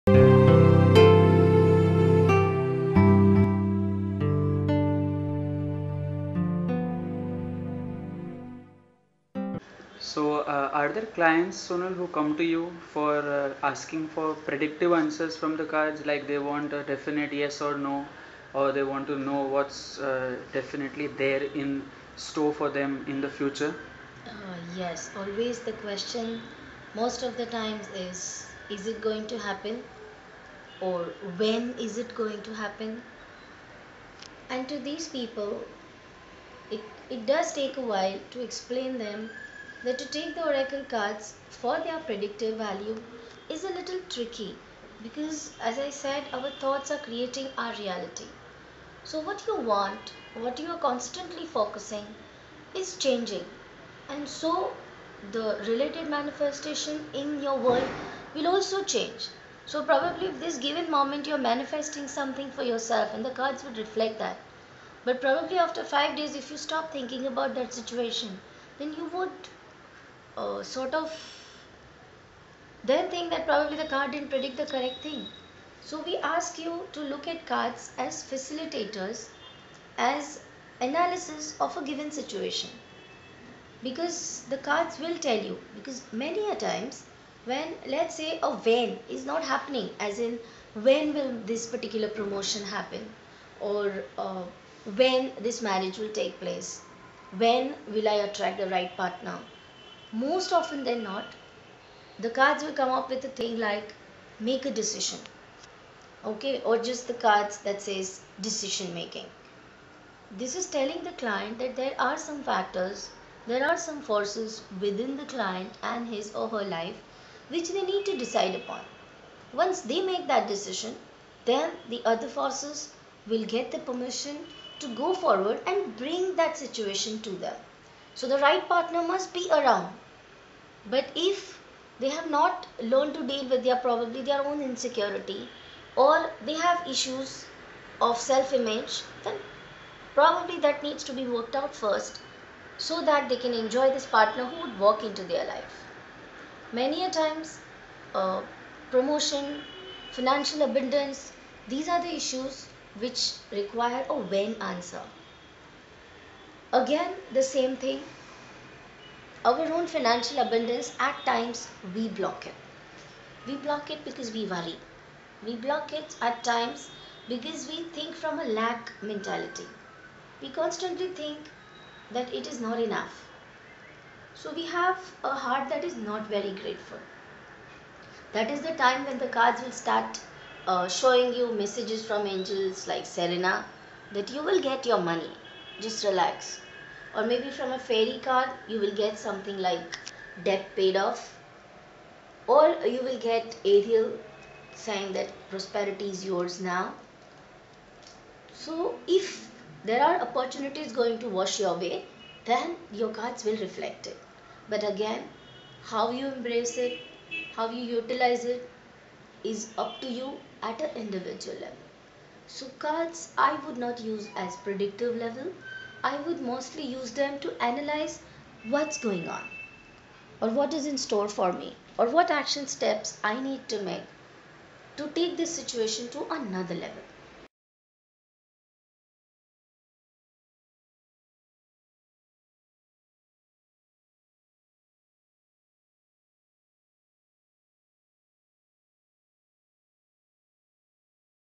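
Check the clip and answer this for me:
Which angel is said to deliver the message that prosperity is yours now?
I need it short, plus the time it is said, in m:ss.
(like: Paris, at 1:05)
Ariel, at 3:13.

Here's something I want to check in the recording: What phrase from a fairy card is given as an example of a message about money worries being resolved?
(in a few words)
Debt paid off.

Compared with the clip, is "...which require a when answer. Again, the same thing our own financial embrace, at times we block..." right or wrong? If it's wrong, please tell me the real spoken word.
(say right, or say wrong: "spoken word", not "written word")
wrong: "abundance", not "embrace".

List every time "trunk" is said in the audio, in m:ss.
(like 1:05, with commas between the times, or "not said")
not said.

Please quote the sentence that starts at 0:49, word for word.
So what you want, what you are constantly focusing is changing and so the related manifestation in your world will also change.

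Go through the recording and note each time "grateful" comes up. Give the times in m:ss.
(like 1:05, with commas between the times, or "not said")
2:56.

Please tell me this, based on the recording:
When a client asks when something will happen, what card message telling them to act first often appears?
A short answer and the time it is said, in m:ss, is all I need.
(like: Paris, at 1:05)
Make a decision, at 1:44.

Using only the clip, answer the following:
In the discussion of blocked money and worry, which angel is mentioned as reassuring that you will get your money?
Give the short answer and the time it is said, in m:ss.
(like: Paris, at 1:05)
Serena, at 3:03.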